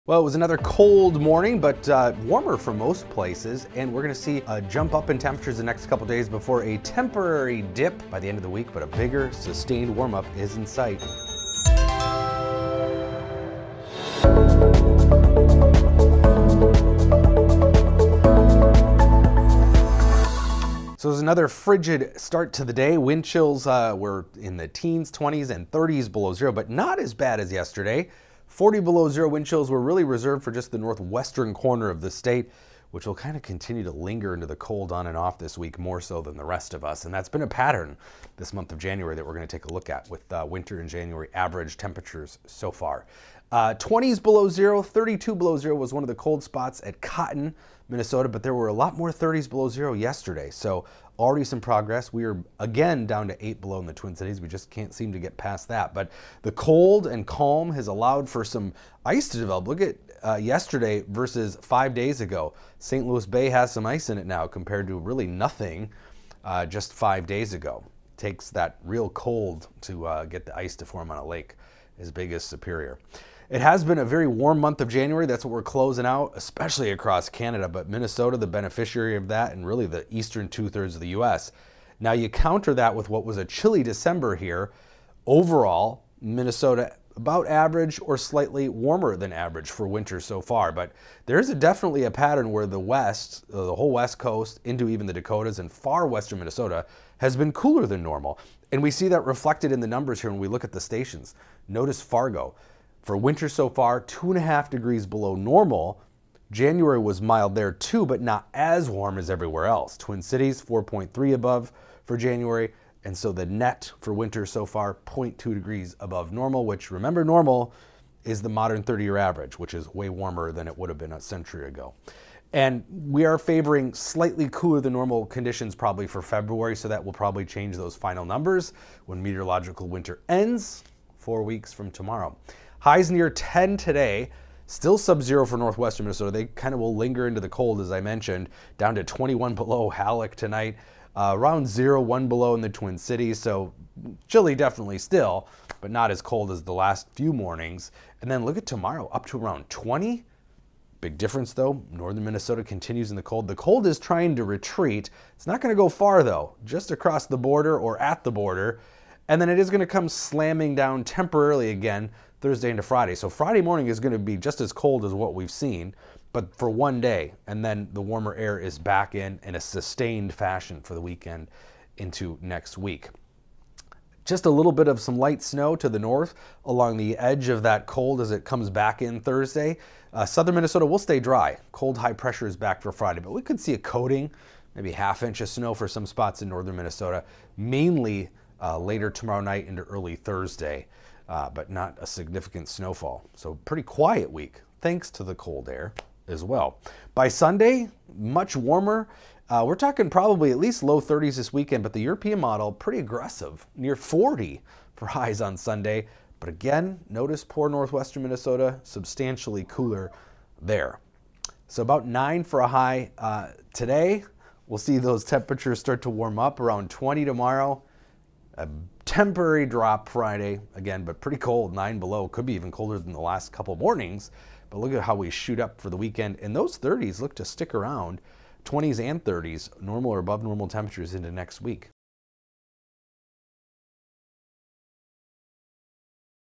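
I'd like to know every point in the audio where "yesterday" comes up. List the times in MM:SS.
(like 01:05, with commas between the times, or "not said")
00:27, 00:49, 01:00.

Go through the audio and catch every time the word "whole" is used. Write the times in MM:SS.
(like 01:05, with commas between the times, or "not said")
01:33.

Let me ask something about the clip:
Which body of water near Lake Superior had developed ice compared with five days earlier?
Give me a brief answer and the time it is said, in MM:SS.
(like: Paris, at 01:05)
St. Louis Bay, at 01:02.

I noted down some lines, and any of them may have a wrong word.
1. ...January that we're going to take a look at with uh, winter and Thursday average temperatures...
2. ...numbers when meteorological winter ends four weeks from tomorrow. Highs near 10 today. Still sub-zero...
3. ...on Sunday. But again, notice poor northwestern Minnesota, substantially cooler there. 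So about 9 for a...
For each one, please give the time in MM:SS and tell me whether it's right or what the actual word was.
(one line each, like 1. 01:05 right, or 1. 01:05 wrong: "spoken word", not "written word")
1. 00:38 wrong: "January", not "Thursday"
2. 02:08 right
3. 03:25 right.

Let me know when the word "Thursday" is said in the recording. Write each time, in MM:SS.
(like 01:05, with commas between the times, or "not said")
02:42, 02:59, 03:10.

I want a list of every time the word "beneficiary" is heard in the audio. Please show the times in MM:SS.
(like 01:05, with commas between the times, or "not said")
01:18.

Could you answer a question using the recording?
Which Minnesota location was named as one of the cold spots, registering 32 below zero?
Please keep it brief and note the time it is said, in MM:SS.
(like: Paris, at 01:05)
Cotton, Minnesota, at 00:47.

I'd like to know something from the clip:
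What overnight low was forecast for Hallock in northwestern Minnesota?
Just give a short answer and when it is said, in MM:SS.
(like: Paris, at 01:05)
21 below, at 02:19.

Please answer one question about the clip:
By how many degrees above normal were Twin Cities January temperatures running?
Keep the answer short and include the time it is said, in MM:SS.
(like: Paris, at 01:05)
4.3, at 01:50.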